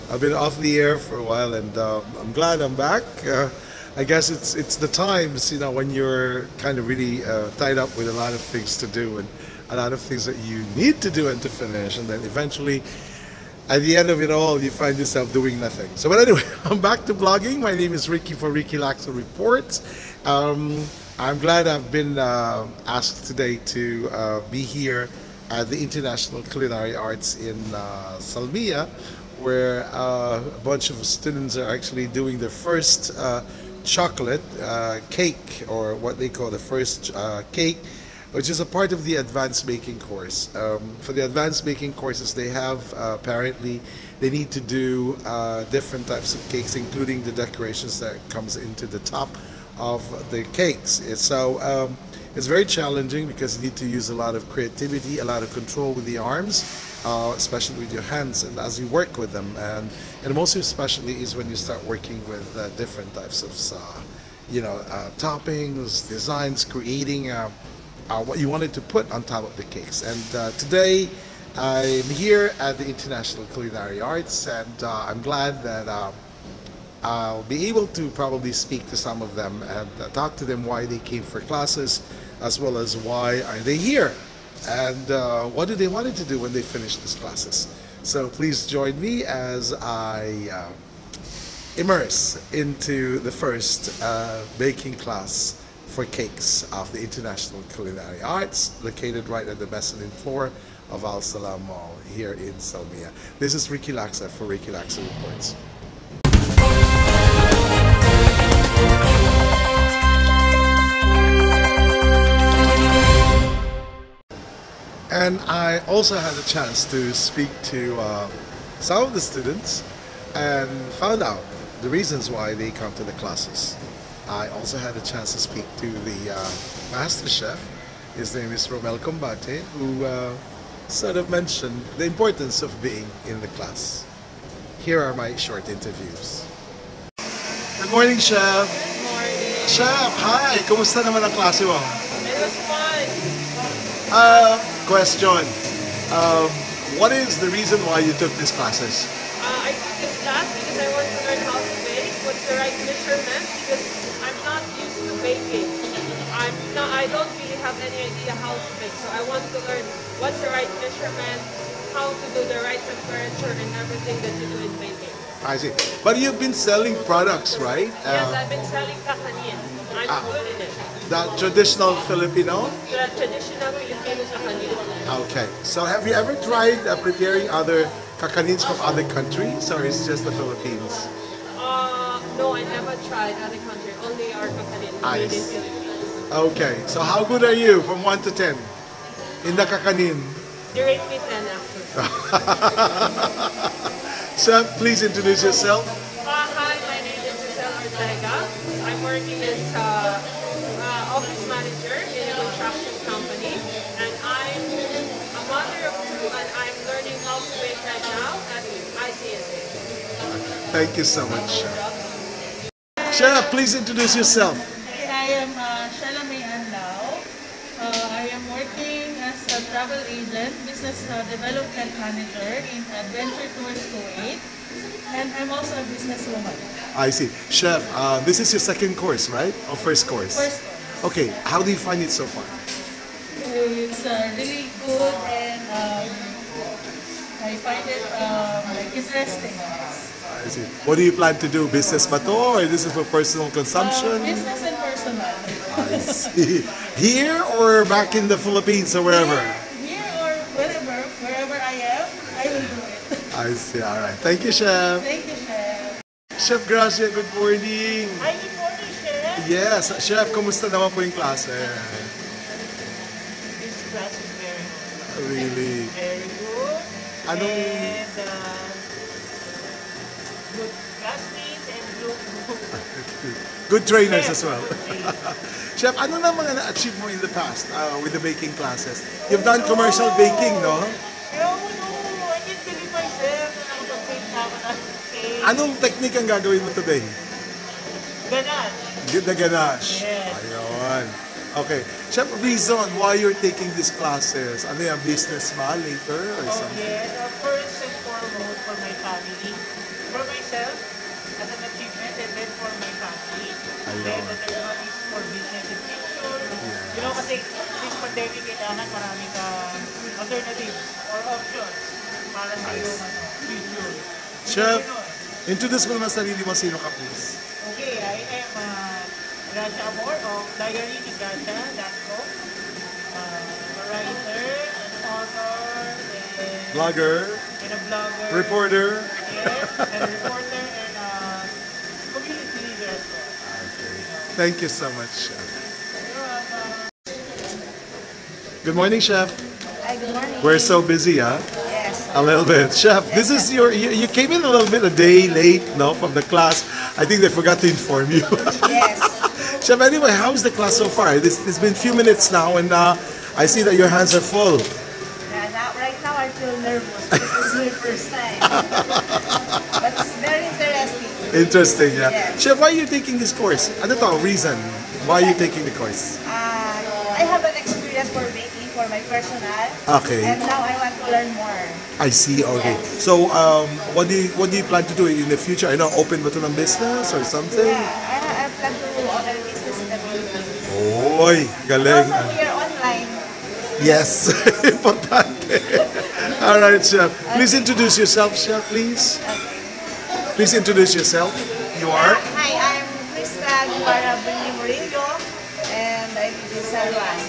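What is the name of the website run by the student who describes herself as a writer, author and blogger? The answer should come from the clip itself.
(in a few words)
Diary ni Raja.com.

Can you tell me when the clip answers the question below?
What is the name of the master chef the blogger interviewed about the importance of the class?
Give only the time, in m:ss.
2:08.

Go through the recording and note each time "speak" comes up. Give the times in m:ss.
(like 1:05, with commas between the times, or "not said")
1:18, 1:57, 2:05.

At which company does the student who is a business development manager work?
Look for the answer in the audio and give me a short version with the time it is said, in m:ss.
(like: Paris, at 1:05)
Adventure Tours Kuwait, at 3:42.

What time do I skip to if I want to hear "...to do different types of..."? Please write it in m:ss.
0:44.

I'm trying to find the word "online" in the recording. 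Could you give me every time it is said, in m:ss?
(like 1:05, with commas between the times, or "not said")
6:22.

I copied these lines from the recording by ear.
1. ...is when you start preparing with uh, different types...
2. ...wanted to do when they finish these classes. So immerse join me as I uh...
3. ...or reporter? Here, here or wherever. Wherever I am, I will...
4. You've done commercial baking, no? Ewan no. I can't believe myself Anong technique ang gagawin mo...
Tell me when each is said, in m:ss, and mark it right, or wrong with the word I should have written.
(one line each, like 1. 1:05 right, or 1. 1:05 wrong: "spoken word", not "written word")
1. 1:01 wrong: "working", not "preparing"
2. 1:25 wrong: "please", not "immerse"
3. 4:08 wrong: "wherever", not "reporter"
4. 4:39 right.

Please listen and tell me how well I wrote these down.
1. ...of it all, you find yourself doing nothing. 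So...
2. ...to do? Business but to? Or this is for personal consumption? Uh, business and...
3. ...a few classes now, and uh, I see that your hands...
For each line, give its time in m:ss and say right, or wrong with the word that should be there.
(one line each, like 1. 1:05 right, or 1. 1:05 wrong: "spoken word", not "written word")
1. 0:14 right
2. 4:01 right
3. 5:51 wrong: "minutes", not "classes".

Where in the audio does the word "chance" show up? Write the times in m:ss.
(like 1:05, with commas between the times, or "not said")
1:56, 2:04.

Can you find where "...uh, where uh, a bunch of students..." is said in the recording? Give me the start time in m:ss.
0:27.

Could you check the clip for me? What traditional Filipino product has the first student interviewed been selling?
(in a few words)
tahaniyan.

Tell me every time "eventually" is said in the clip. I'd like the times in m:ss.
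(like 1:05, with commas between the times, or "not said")
0:12.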